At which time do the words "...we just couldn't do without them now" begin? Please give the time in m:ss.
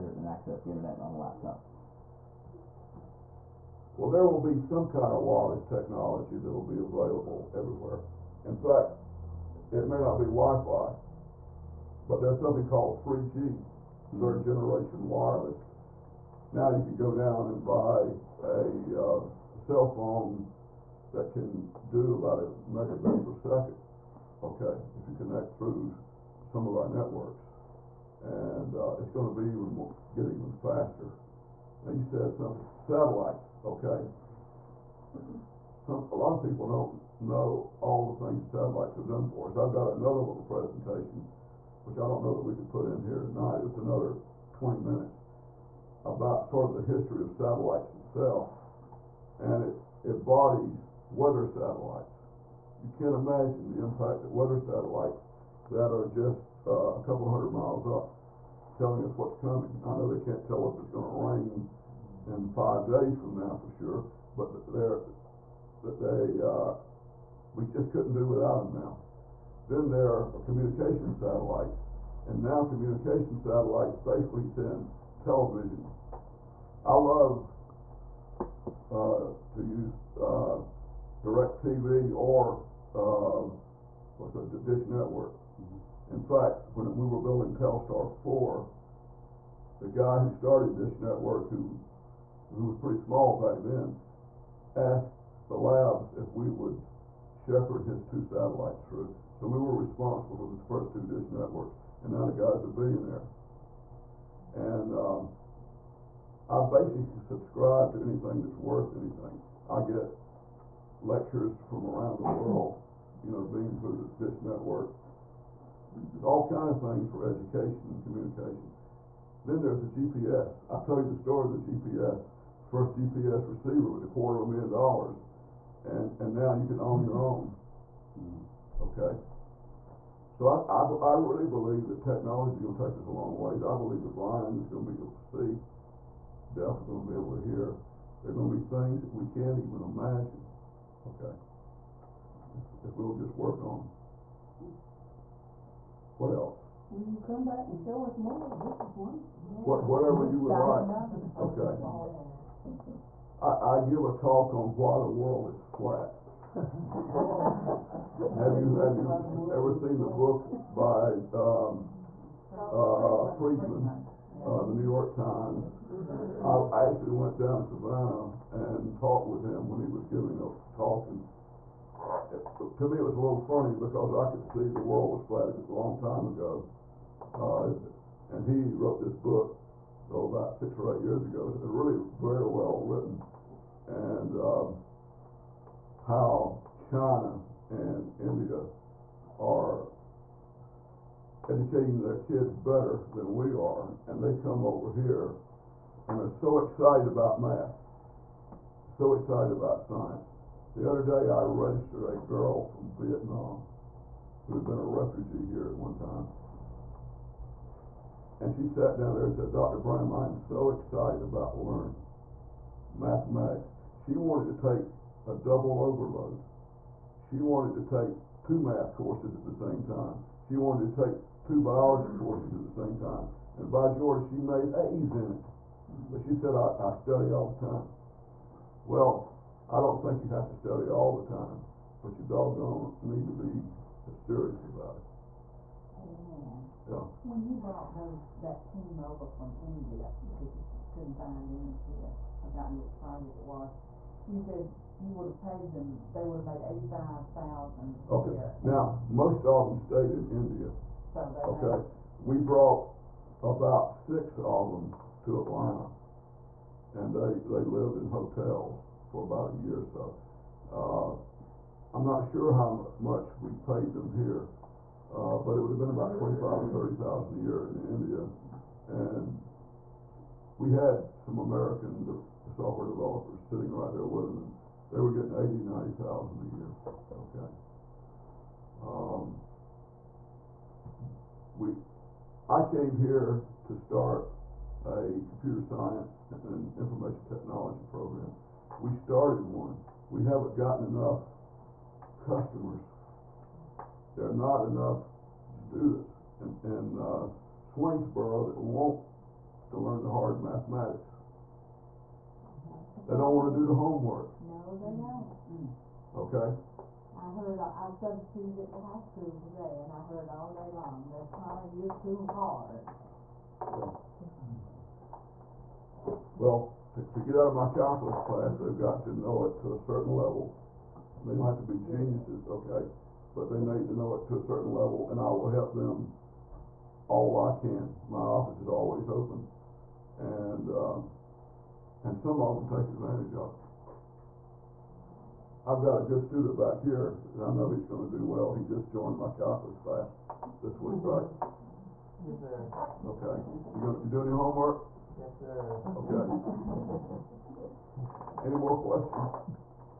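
1:07.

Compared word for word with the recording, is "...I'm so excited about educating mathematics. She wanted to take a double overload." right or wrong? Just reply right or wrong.
wrong.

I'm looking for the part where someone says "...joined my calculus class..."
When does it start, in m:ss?
5:38.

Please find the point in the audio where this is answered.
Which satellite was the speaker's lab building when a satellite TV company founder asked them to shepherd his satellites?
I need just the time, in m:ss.
1:27.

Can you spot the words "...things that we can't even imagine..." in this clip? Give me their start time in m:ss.
2:18.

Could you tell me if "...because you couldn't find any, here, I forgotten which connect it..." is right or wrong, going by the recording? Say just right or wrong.
wrong.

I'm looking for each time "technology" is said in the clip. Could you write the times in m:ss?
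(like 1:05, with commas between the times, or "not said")
0:05, 2:12, 4:47.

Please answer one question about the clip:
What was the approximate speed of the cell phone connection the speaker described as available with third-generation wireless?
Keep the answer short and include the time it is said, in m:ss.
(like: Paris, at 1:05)
1 megabit per second, at 0:22.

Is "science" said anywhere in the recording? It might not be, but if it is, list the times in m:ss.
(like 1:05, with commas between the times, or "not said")
3:19, 4:45.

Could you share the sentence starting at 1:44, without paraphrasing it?
And um, I basically subscribe to anything that's worth anything.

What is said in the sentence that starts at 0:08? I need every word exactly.
In fact, it may not be Wi-Fi, but there's something called 3G, hmm.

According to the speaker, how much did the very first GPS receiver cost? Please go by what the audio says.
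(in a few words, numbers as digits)
$250,000.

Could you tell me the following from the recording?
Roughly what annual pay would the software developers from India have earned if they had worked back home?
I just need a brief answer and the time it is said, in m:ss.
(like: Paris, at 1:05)
$30,000, at 4:26.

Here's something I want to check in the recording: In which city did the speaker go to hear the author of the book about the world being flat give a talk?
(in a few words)
Savannah.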